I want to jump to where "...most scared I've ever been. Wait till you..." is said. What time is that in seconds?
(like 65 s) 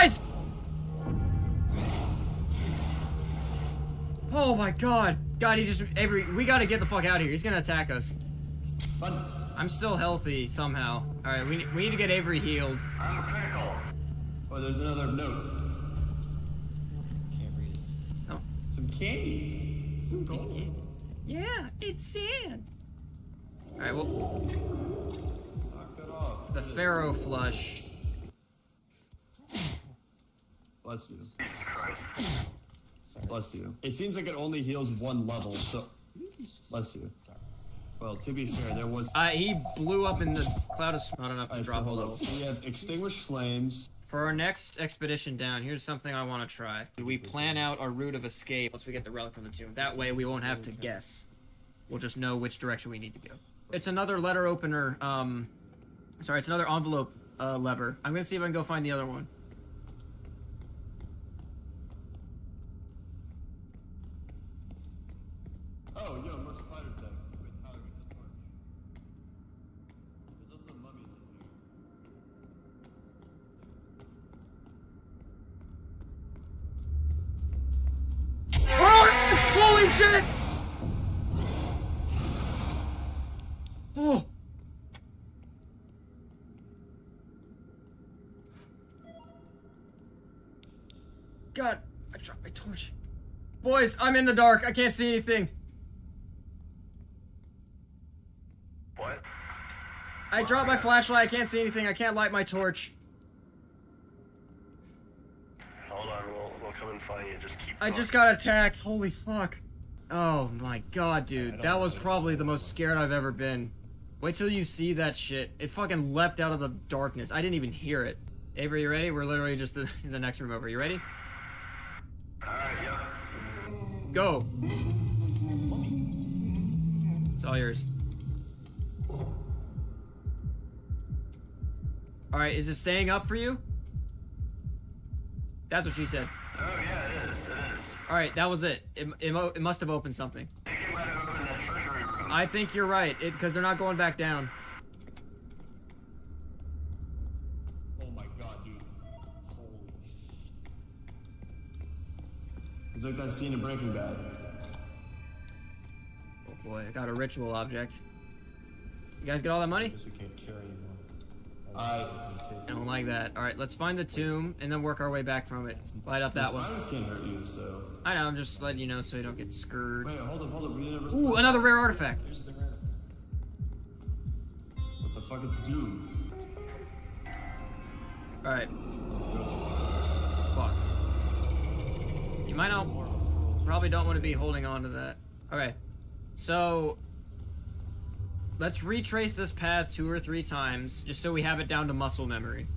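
112 s.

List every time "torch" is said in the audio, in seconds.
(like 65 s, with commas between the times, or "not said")
92 s, 102 s.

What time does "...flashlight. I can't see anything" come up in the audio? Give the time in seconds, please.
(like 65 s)
100 s.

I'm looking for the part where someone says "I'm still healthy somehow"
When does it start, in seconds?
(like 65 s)
9 s.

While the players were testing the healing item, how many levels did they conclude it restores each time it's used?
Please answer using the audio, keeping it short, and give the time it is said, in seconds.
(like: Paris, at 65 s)
1, at 34 s.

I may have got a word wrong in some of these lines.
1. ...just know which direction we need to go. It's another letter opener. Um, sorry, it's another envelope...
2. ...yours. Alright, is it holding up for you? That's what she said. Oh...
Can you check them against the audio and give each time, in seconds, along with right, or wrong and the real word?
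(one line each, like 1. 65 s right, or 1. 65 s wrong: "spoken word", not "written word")
1. 51 s right
2. 127 s wrong: "staying", not "holding".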